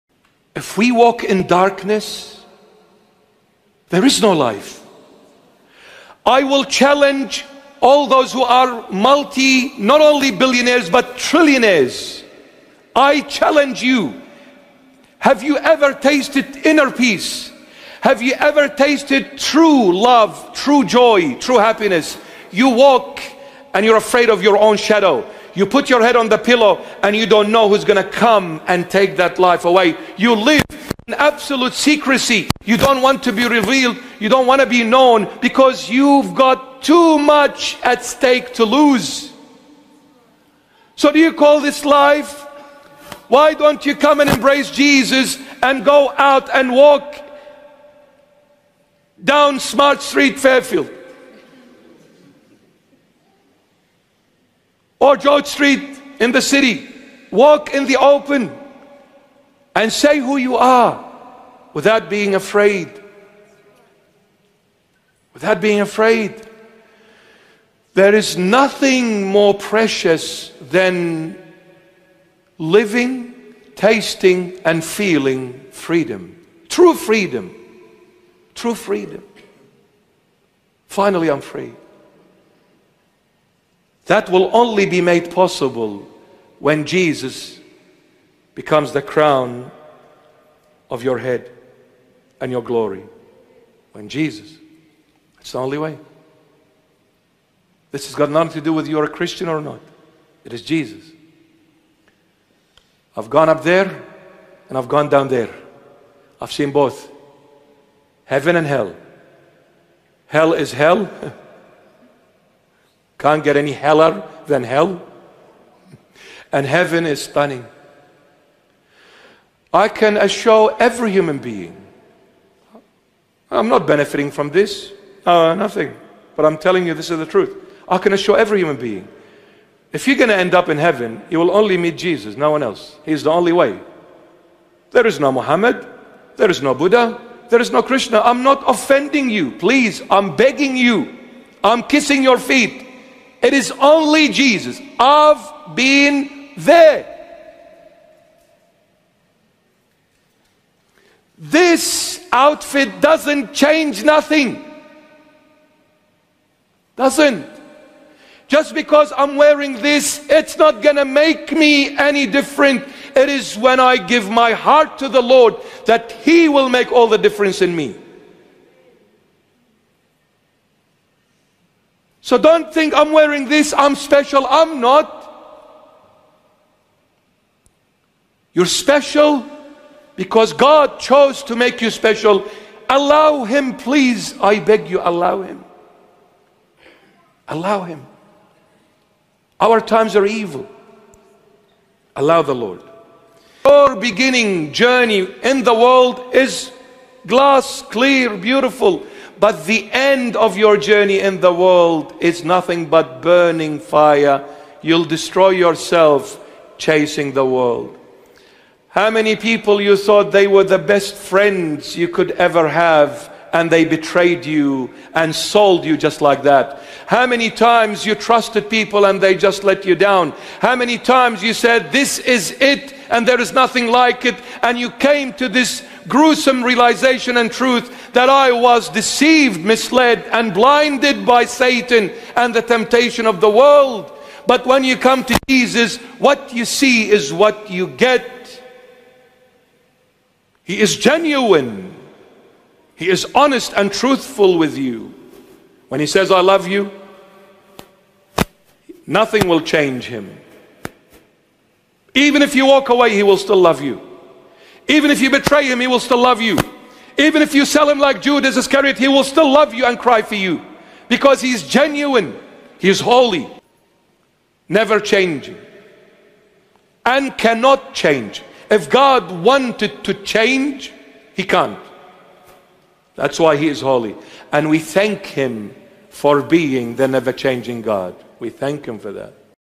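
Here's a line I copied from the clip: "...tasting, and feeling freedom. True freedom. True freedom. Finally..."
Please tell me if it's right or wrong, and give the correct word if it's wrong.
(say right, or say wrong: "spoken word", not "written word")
right.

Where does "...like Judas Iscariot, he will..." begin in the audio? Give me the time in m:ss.
4:17.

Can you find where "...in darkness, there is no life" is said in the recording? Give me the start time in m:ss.
0:01.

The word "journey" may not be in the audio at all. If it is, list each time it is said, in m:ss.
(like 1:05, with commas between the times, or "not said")
3:14, 3:20.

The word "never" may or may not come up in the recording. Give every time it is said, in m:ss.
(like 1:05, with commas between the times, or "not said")
4:24, 4:37.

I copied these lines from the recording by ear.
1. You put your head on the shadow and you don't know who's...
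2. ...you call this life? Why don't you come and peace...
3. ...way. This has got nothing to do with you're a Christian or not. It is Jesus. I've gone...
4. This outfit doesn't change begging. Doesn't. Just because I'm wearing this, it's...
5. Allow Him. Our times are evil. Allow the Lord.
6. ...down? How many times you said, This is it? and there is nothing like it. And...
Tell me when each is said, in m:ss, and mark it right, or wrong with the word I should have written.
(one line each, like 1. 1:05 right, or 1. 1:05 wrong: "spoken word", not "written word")
1. 0:25 wrong: "pillow", not "shadow"
2. 0:41 wrong: "embrace", not "peace"
3. 1:35 right
4. 2:31 wrong: "nothing", not "begging"
5. 3:07 right
6. 3:39 right.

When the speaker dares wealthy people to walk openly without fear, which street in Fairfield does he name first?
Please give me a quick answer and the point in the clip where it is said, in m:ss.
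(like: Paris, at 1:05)
Smart Street, at 0:49.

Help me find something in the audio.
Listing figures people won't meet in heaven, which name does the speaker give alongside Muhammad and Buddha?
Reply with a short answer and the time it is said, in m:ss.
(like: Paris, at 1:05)
Krishna, at 2:17.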